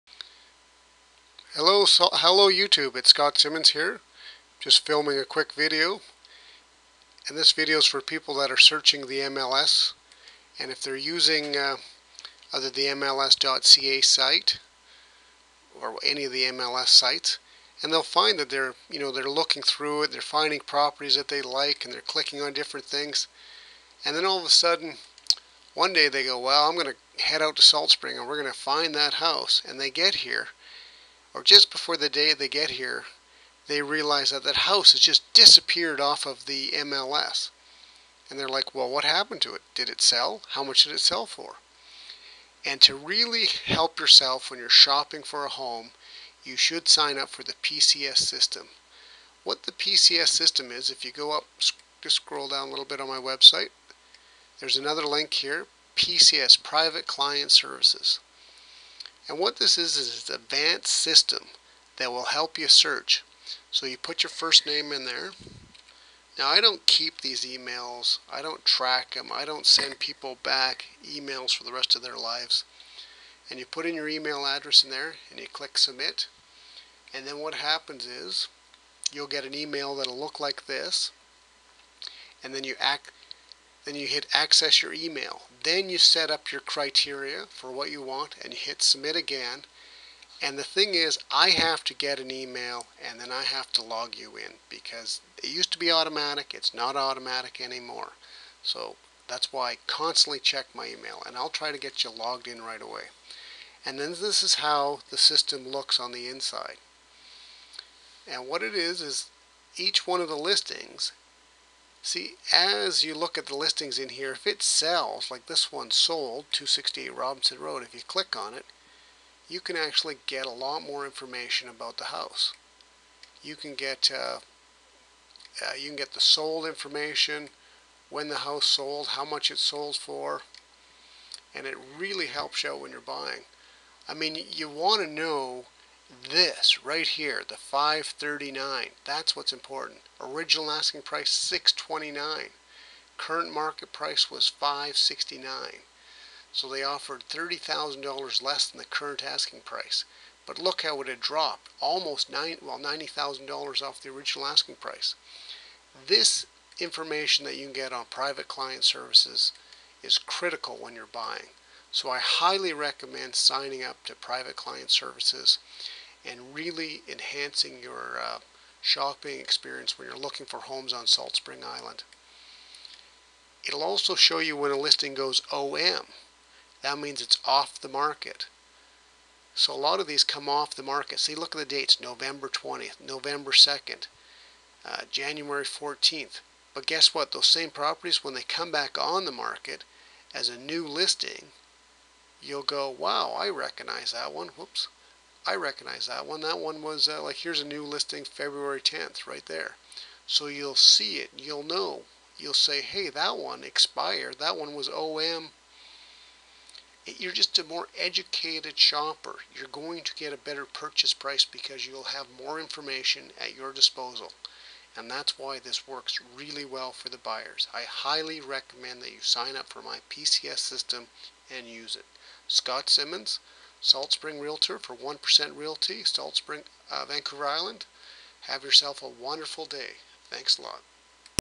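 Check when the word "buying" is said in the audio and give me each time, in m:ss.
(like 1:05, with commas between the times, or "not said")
2:13, 2:41.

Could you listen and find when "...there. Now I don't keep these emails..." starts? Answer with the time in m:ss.
1:05.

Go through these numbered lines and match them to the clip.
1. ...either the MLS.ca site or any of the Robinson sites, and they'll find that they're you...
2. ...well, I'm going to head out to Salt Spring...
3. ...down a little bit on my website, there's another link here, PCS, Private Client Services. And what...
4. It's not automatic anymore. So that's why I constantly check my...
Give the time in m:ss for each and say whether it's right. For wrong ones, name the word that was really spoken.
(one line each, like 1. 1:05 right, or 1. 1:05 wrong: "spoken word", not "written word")
1. 0:12 wrong: "MLS", not "Robinson"
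2. 0:26 right
3. 0:52 right
4. 1:36 right.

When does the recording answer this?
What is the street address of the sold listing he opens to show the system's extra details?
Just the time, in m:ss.
1:56.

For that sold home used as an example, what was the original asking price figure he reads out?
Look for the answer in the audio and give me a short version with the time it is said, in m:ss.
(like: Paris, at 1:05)
629, at 2:21.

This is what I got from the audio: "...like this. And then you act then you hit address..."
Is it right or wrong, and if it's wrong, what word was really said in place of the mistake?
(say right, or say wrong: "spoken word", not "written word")
wrong: "access", not "address".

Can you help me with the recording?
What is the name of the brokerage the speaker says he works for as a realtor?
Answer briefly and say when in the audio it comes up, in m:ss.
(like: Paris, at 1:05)
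1% Realty, at 3:44.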